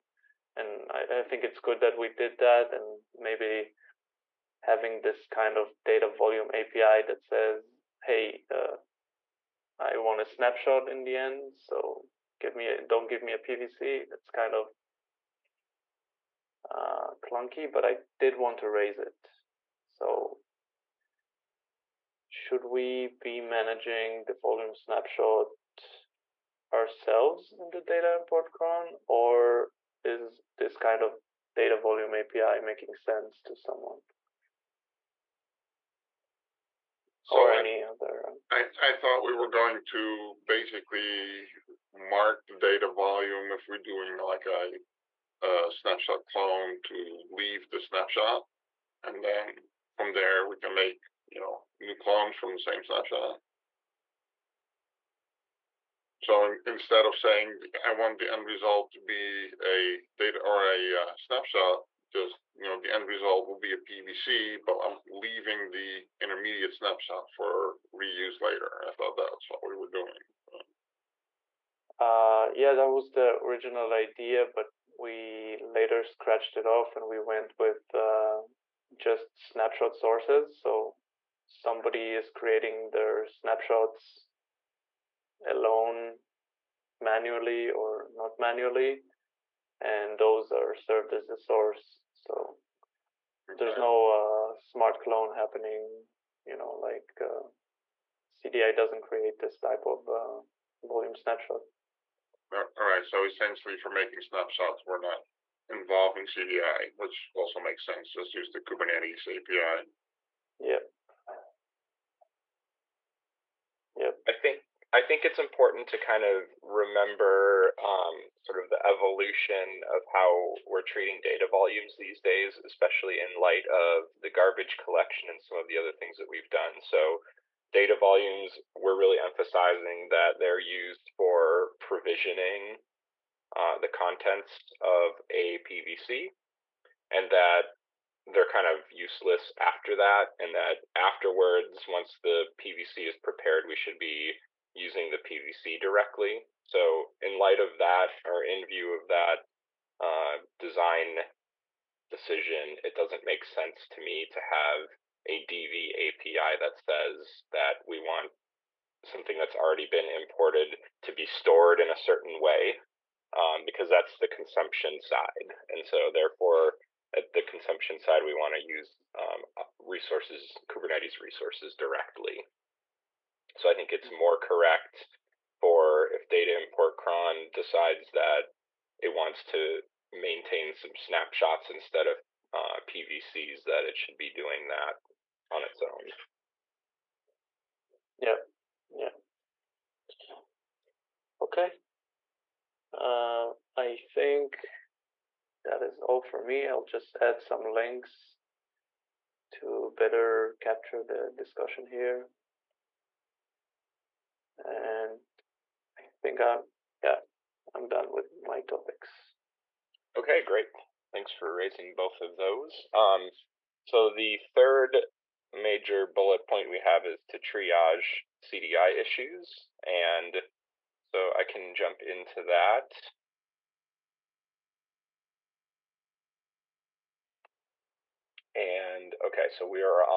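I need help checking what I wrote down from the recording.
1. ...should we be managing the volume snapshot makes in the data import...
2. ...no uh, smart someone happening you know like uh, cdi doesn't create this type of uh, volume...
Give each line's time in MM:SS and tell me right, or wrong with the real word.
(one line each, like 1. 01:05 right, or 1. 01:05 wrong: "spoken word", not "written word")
1. 00:22 wrong: "ourselves", not "makes"
2. 01:33 wrong: "clone", not "someone".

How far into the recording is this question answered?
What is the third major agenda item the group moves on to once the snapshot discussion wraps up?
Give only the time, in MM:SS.
03:37.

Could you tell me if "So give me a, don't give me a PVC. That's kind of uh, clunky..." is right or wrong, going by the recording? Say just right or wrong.
right.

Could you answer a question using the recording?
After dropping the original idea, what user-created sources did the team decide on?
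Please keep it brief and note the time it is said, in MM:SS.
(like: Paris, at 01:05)
snapshot sources, at 01:19.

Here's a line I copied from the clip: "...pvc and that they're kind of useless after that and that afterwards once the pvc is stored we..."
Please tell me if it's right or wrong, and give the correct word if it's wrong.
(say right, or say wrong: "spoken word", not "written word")
wrong: "prepared", not "stored".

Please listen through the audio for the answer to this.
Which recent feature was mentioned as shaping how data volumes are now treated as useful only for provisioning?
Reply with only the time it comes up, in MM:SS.
02:04.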